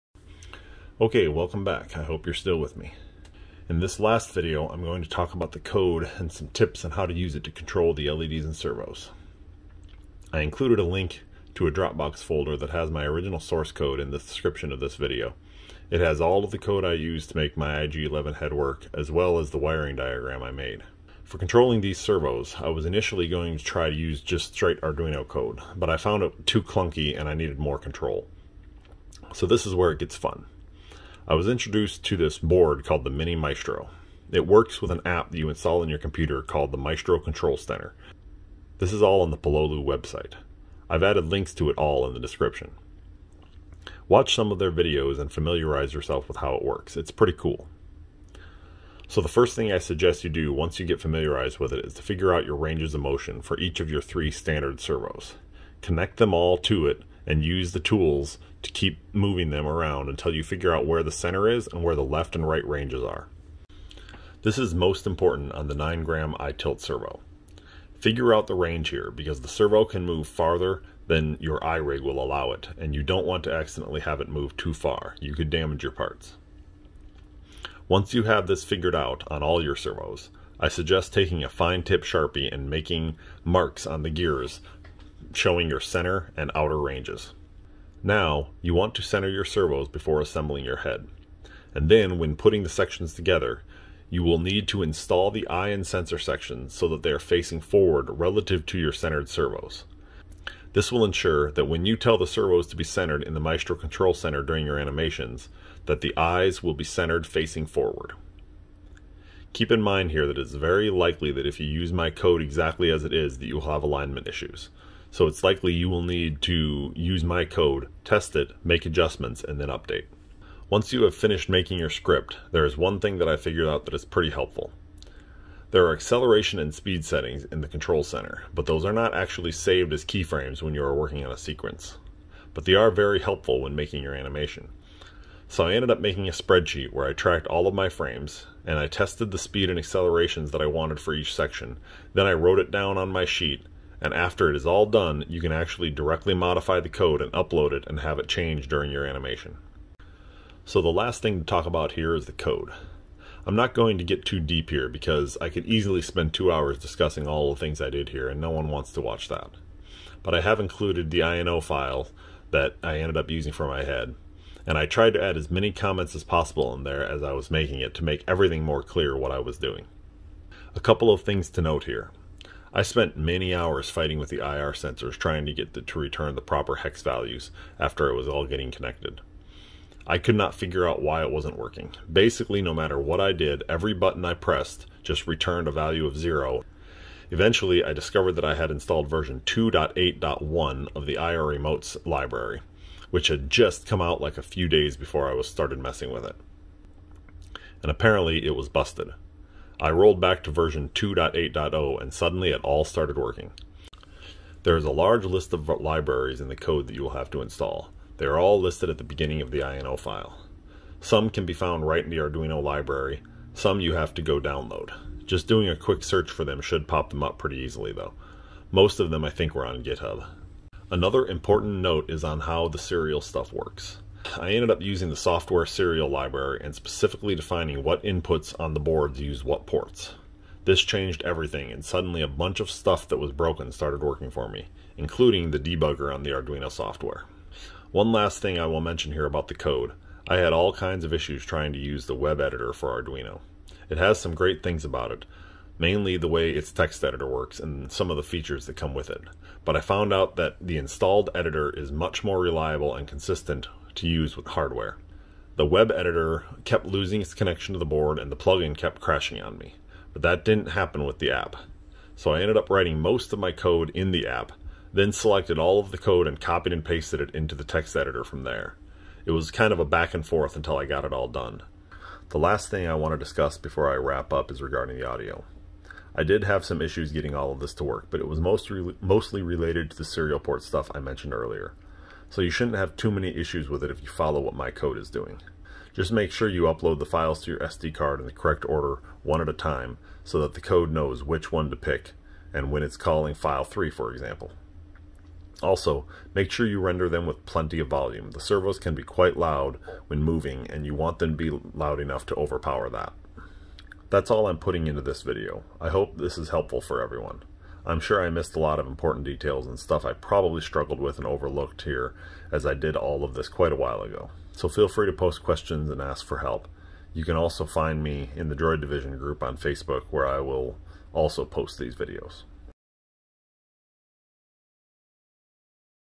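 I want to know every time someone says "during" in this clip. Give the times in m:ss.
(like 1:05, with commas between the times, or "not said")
1:44, 2:28.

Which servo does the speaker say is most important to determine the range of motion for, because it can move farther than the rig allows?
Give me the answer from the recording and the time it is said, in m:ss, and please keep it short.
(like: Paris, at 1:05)
9 gram eye tilt servo, at 1:05.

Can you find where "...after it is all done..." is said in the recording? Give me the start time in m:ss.
2:24.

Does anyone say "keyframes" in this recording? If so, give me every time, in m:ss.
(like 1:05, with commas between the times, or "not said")
2:10.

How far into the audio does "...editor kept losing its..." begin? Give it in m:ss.
4:15.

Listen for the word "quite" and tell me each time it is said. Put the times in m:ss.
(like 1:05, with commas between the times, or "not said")
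4:59, 5:13.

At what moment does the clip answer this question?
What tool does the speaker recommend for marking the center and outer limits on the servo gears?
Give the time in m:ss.
1:21.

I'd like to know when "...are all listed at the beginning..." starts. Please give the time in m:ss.
3:28.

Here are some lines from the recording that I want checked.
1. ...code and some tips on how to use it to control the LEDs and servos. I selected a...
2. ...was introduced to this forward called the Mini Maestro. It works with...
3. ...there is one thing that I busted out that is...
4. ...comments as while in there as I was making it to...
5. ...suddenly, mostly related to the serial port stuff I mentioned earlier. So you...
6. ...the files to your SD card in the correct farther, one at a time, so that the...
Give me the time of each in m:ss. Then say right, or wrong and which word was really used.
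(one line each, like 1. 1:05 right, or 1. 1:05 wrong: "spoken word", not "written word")
1. 0:05 wrong: "included", not "selected"
2. 0:31 wrong: "board", not "forward"
3. 2:02 wrong: "figured", not "busted"
4. 2:45 wrong: "possible", not "while"
5. 4:38 wrong: "mostly", not "suddenly"
6. 4:46 wrong: "order", not "farther".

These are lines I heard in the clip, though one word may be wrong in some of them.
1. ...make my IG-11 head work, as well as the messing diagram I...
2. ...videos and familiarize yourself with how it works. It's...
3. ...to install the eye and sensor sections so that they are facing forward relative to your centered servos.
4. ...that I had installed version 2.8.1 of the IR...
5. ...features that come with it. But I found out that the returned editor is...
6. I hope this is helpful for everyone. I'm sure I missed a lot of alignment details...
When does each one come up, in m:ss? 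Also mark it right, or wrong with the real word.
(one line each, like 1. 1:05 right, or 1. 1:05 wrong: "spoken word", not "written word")
1. 0:17 wrong: "wiring", not "messing"
2. 0:44 right
3. 1:34 right
4. 3:08 right
5. 4:08 wrong: "installed", not "returned"
6. 5:05 wrong: "important", not "alignment".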